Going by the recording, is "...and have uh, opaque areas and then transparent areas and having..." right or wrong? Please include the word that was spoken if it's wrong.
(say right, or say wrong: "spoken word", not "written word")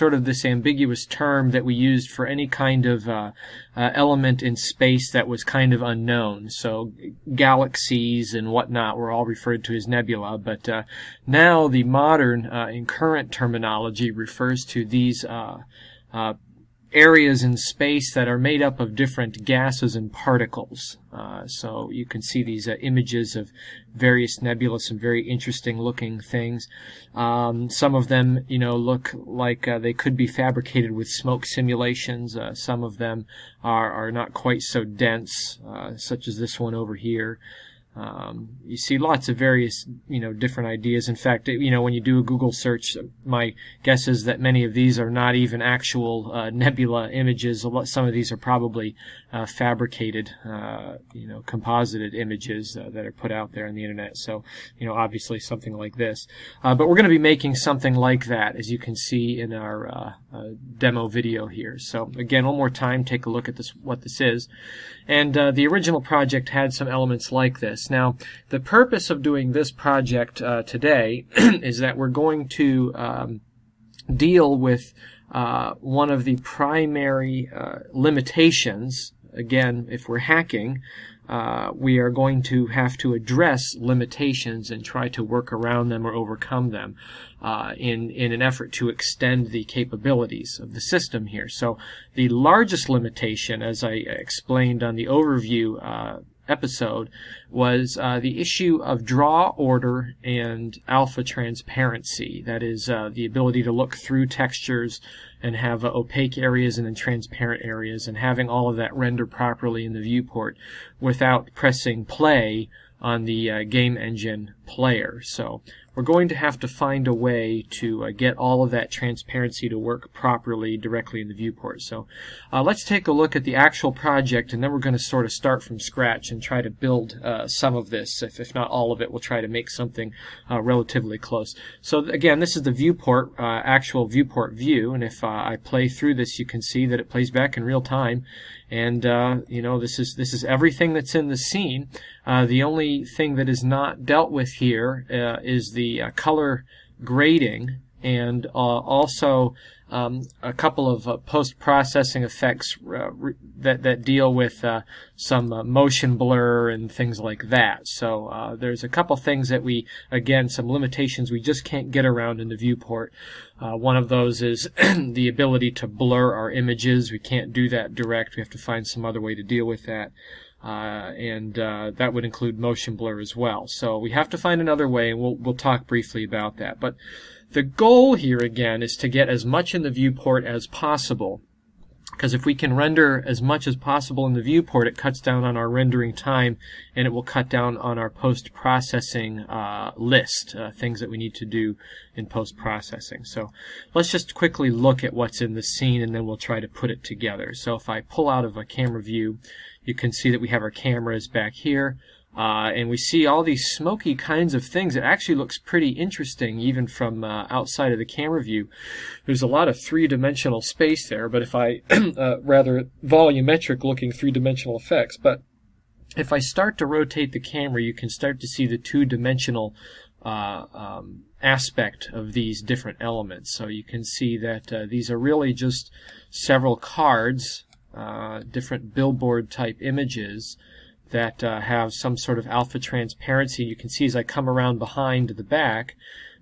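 right.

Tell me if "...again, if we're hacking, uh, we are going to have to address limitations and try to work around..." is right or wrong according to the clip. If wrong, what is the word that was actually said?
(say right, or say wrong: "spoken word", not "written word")
right.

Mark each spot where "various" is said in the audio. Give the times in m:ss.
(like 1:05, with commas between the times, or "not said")
0:23, 0:39.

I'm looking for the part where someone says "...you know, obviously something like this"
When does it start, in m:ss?
0:54.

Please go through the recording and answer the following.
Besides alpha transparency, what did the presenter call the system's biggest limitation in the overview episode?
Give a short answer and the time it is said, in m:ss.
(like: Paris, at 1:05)
draw order, at 1:39.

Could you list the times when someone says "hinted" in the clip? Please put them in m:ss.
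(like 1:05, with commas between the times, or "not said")
not said.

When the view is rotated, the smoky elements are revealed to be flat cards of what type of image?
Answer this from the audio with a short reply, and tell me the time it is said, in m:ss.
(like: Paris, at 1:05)
billboard, at 3:48.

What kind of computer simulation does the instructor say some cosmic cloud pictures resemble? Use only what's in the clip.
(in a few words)
smoke simulations.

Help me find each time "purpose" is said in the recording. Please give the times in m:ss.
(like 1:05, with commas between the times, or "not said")
1:08.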